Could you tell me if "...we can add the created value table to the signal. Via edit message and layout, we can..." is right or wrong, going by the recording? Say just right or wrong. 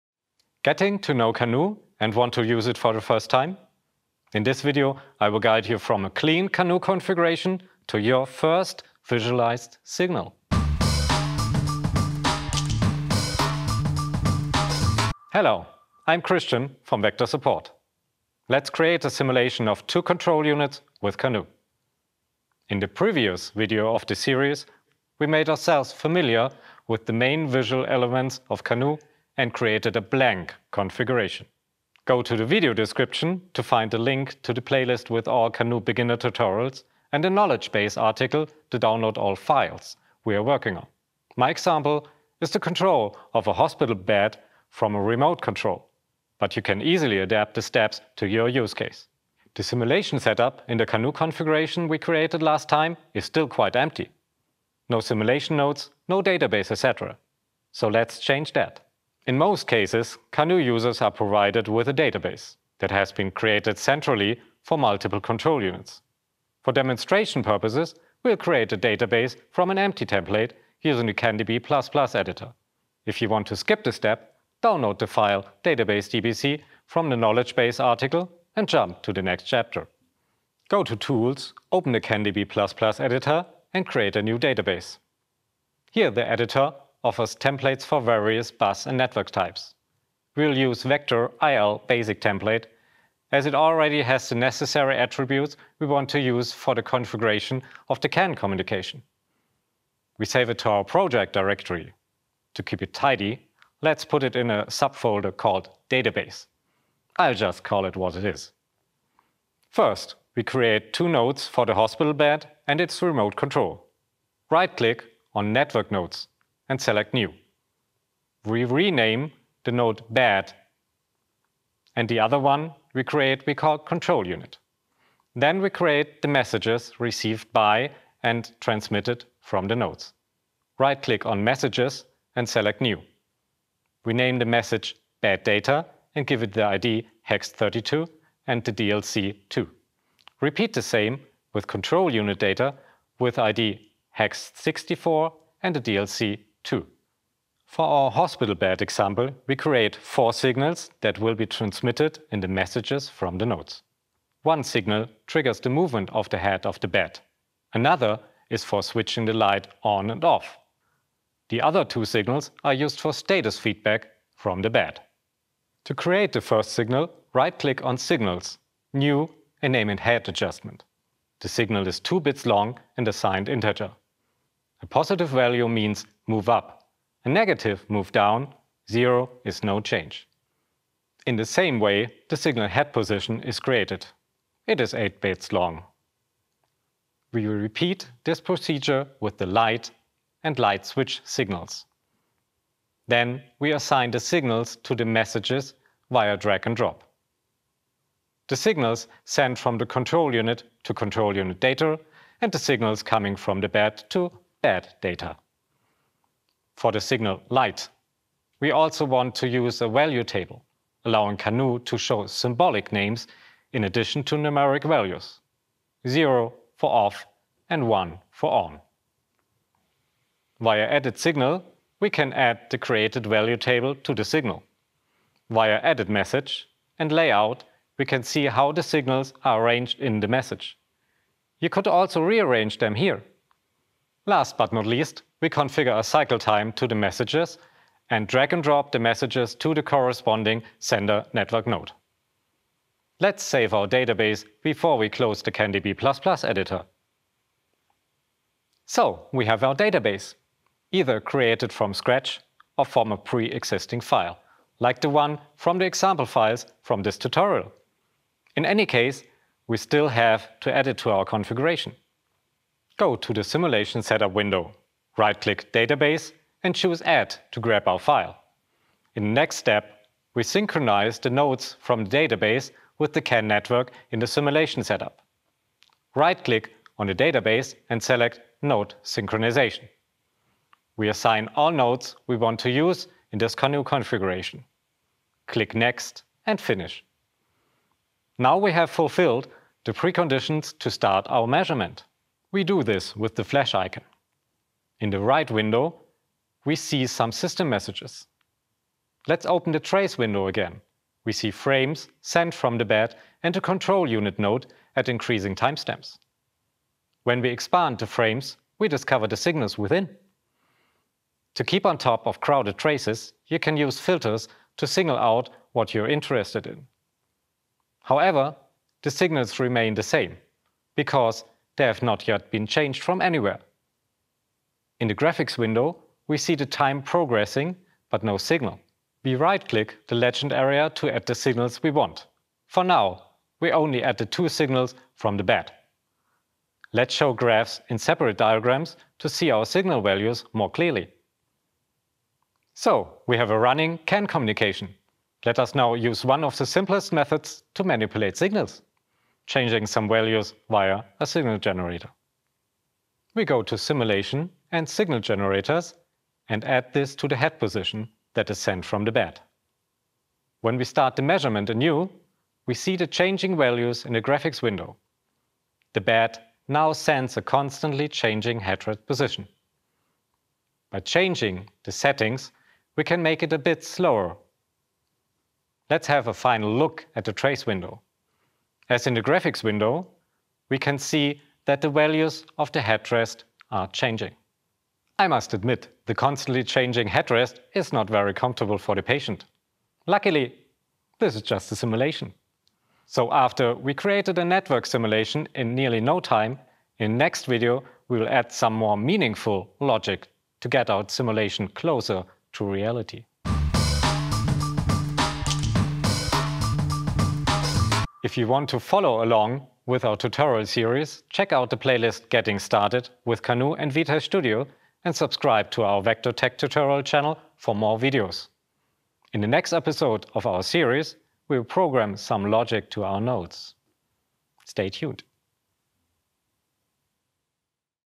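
right.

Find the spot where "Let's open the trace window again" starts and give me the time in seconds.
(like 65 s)
299 s.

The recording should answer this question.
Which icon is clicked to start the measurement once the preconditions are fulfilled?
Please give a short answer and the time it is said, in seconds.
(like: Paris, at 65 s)
Flash icon, at 293 s.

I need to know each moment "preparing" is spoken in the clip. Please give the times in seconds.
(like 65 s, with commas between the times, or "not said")
not said.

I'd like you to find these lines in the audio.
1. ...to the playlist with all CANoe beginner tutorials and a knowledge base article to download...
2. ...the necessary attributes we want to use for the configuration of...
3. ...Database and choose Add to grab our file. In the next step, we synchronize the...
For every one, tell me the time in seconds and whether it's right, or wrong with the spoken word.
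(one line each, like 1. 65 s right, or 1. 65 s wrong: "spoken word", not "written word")
1. 34 s right
2. 94 s right
3. 265 s right.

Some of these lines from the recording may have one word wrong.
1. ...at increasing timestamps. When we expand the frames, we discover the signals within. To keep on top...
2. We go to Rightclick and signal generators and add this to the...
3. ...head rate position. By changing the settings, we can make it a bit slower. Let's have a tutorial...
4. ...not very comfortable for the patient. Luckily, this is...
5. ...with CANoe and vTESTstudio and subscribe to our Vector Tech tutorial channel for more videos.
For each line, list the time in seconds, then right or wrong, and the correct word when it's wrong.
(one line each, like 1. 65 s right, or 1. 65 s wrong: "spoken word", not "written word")
1. 304 s right
2. 353 s wrong: "Simulation", not "Rightclick"
3. 368 s wrong: "final", not "tutorial"
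4. 387 s right
5. 413 s right.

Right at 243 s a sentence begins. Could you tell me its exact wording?
Let's save our database before we close the CanDB++ editor.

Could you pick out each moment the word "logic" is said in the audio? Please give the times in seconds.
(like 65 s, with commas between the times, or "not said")
399 s, 422 s.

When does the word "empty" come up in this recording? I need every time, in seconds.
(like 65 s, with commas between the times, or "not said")
53 s, 69 s.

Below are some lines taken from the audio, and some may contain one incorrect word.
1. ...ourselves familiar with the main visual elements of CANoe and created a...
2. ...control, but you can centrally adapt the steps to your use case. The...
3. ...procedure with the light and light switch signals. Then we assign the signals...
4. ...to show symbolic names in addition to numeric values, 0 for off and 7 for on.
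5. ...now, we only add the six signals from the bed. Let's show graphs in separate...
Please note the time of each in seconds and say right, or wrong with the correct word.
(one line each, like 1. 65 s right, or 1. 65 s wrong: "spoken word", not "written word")
1. 25 s right
2. 45 s wrong: "easily", not "centrally"
3. 188 s right
4. 211 s wrong: "1", not "7"
5. 332 s wrong: "two", not "six".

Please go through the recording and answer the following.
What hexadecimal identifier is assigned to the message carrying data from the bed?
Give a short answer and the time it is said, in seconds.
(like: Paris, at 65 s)
hex32, at 137 s.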